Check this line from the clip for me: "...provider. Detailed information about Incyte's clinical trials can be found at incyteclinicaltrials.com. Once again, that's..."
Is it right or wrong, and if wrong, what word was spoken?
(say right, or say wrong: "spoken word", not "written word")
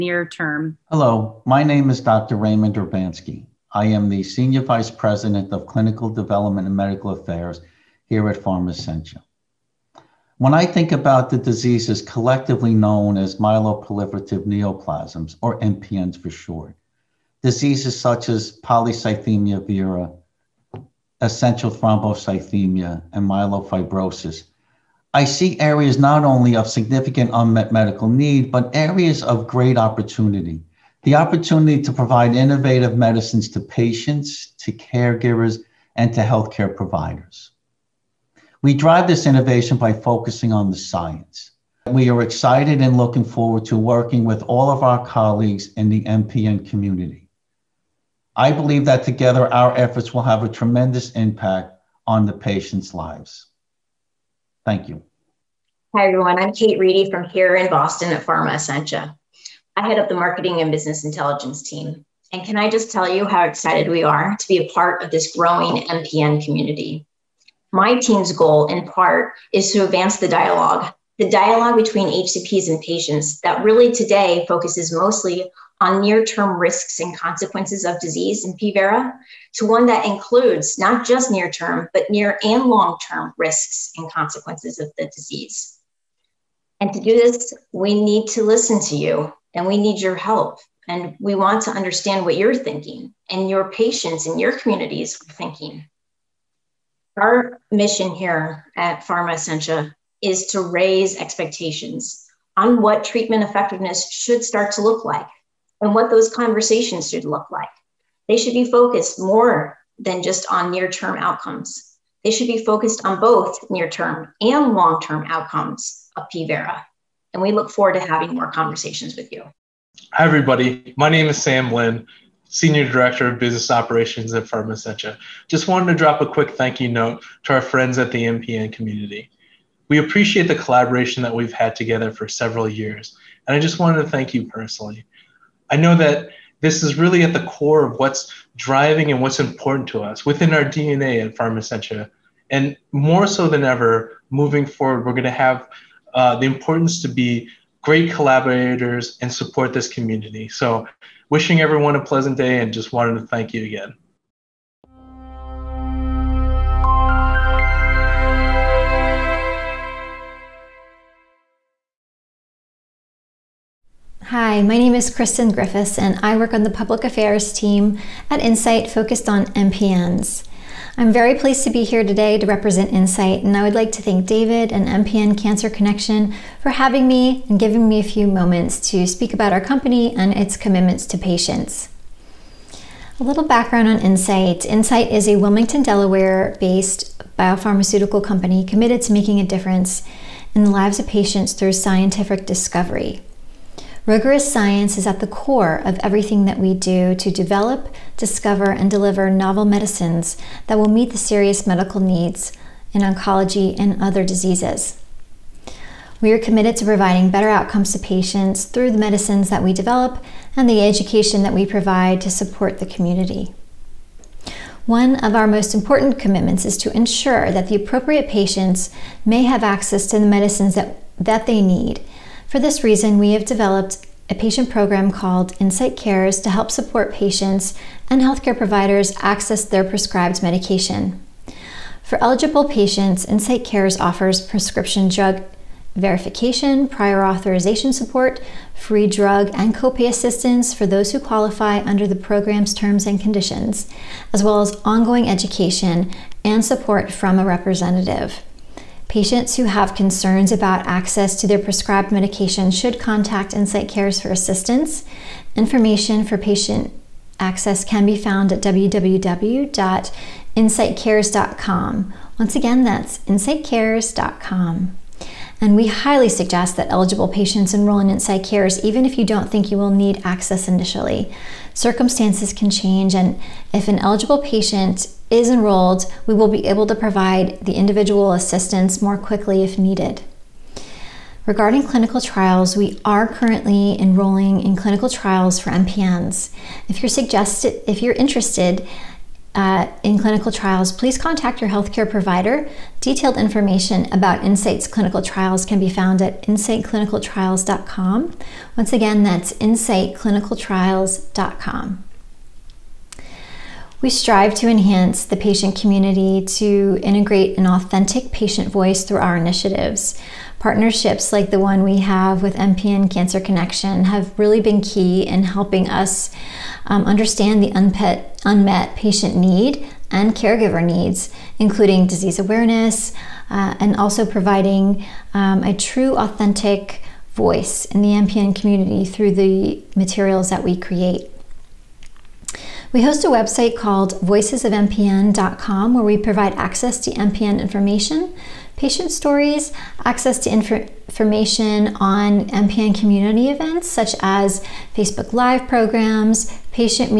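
right.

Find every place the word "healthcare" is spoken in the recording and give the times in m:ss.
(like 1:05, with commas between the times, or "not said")
0:36, 3:48, 4:51.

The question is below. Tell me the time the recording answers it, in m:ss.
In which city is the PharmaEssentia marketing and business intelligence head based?
0:57.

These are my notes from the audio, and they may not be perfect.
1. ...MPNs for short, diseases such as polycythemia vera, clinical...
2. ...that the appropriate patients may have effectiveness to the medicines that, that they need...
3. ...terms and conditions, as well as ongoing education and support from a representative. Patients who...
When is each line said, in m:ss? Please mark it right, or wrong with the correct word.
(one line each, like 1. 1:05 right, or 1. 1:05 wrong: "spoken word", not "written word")
1. 0:15 wrong: "essential", not "clinical"
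2. 3:37 wrong: "access", not "effectiveness"
3. 4:02 right.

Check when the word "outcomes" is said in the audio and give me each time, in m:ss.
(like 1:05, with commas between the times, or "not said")
1:51, 1:55, 3:27.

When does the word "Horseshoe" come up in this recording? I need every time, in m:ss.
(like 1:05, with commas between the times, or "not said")
not said.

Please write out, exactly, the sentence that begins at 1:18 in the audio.
vera to one that includes not just near term, but near and long term risks and consequences of the disease.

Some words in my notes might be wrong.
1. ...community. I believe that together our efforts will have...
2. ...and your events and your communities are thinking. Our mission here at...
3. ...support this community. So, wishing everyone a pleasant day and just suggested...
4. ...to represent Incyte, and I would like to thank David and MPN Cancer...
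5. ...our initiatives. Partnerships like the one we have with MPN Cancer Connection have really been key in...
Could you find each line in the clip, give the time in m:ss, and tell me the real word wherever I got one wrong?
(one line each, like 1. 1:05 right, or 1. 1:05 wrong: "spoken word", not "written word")
1. 0:46 right
2. 1:33 wrong: "patients", not "events"
3. 2:29 wrong: "wanted", not "suggested"
4. 2:52 right
5. 5:09 right.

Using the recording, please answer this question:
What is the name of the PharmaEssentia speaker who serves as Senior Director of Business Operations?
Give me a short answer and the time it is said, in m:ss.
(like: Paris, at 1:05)
Sam Lynn, at 2:01.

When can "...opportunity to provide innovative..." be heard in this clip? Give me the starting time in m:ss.
0:31.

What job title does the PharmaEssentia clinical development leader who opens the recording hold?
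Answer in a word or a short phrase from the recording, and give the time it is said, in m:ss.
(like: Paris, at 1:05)
Senior Vice President, at 0:04.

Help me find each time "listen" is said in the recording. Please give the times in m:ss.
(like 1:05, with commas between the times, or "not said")
1:28.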